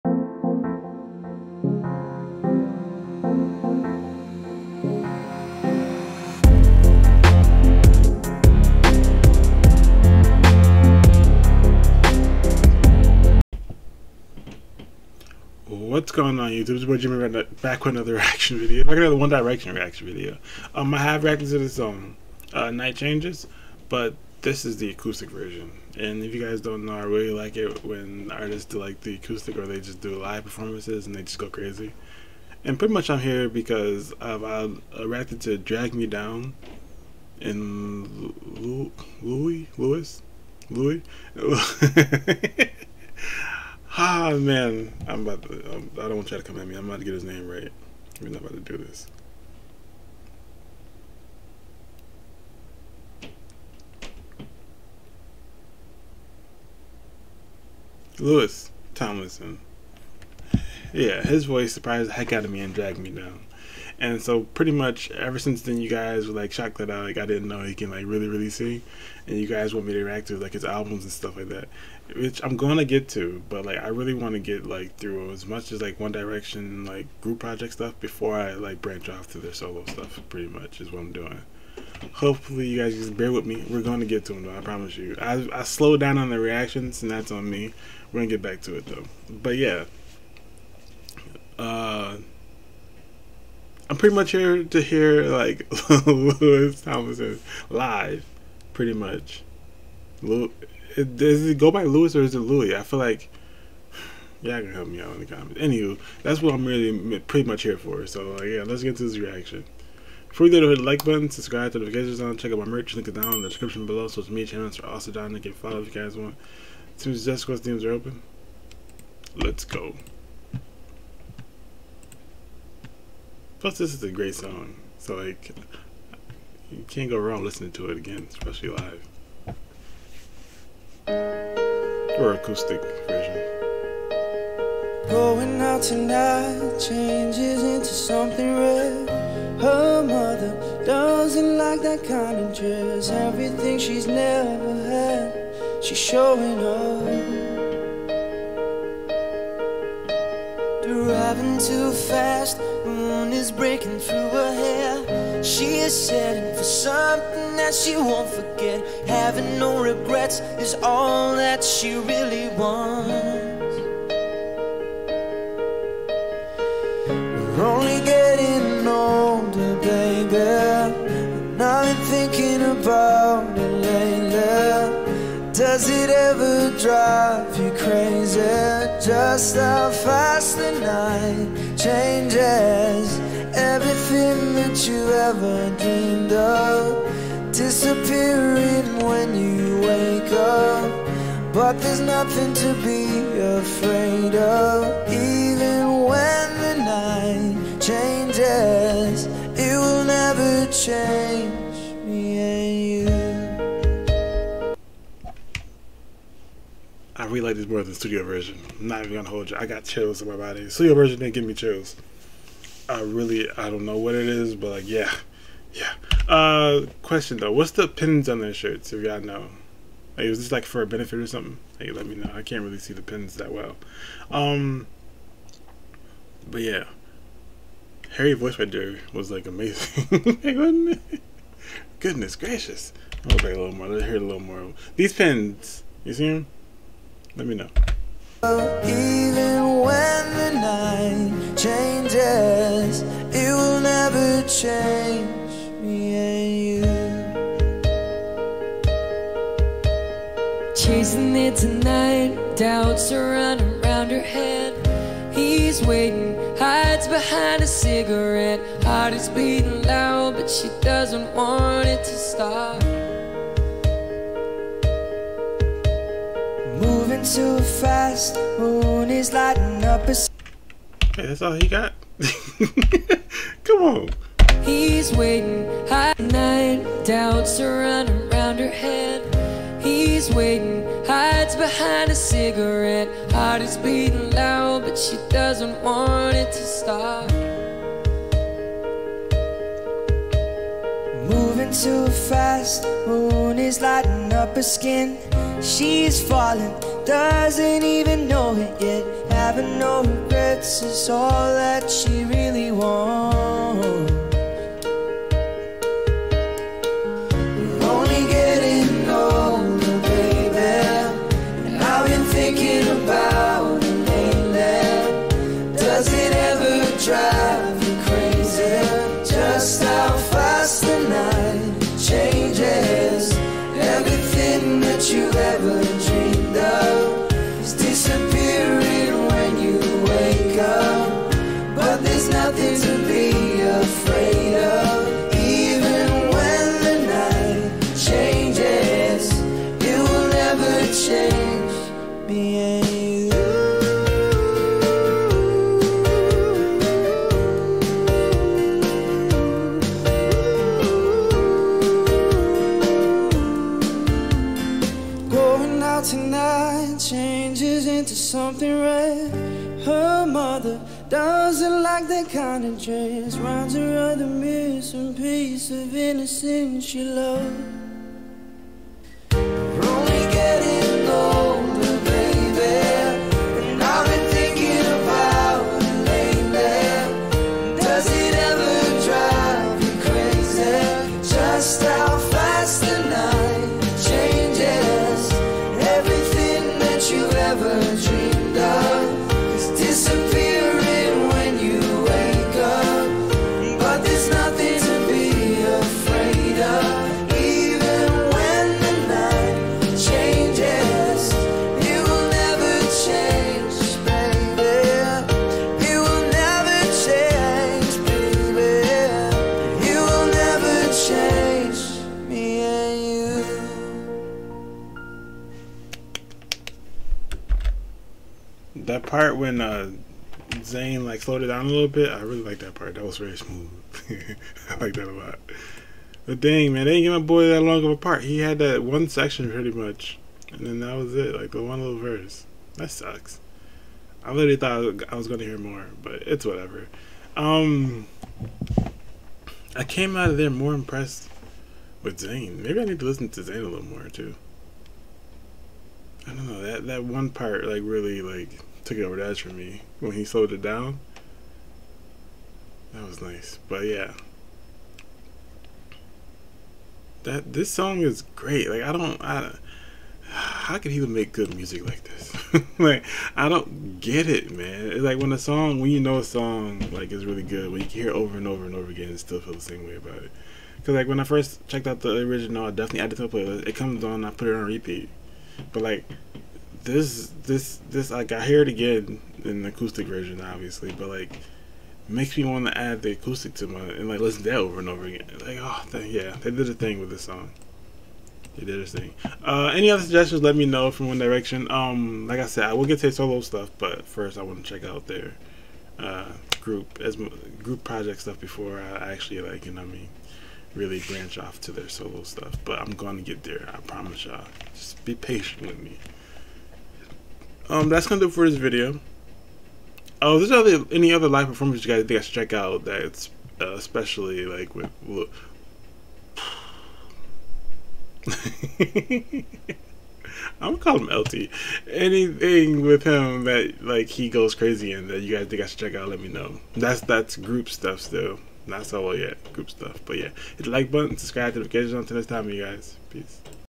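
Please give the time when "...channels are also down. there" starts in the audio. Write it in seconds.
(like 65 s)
114 s.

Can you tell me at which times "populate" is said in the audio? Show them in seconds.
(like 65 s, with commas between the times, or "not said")
not said.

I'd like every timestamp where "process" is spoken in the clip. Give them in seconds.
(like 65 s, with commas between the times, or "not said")
not said.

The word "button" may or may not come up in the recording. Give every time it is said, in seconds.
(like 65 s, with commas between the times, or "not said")
111 s, 530 s.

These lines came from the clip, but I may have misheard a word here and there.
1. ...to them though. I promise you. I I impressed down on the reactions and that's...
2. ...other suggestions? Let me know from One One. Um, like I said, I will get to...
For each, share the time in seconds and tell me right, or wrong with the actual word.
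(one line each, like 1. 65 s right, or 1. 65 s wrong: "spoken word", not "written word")
1. 84 s wrong: "slowed", not "impressed"
2. 489 s wrong: "Direction", not "One".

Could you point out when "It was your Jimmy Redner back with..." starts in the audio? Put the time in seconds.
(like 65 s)
16 s.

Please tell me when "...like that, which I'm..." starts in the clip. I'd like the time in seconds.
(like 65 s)
71 s.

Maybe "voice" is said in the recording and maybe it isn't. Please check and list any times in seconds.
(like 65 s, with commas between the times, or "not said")
61 s, 228 s.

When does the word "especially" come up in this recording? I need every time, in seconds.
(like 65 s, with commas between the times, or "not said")
128 s, 513 s.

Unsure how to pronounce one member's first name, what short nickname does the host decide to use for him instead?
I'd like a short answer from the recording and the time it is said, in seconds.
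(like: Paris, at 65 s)
LT, at 521 s.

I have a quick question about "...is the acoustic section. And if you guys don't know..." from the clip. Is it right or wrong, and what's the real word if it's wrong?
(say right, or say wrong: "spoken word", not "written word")
wrong: "version", not "section".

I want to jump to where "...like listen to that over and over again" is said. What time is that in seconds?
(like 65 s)
484 s.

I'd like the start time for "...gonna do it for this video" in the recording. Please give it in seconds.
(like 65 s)
508 s.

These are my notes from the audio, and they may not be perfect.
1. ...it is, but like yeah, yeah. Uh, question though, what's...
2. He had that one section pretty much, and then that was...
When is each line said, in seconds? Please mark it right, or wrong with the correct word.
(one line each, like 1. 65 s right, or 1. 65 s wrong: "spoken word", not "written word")
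1. 214 s right
2. 428 s right.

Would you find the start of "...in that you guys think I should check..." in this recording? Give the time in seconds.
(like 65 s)
524 s.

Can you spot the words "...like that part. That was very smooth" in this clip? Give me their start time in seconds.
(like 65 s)
422 s.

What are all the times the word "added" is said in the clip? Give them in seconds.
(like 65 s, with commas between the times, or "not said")
473 s.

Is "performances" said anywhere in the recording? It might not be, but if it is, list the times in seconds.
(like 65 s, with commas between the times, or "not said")
30 s, 511 s.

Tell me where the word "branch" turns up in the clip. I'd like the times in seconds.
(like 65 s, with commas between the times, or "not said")
78 s, 501 s.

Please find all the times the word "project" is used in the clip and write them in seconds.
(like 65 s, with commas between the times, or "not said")
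77 s, 497 s.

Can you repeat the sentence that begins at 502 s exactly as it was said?
But I'm going to get there.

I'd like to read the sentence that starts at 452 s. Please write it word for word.
That was nice, but yeah, that this song is great.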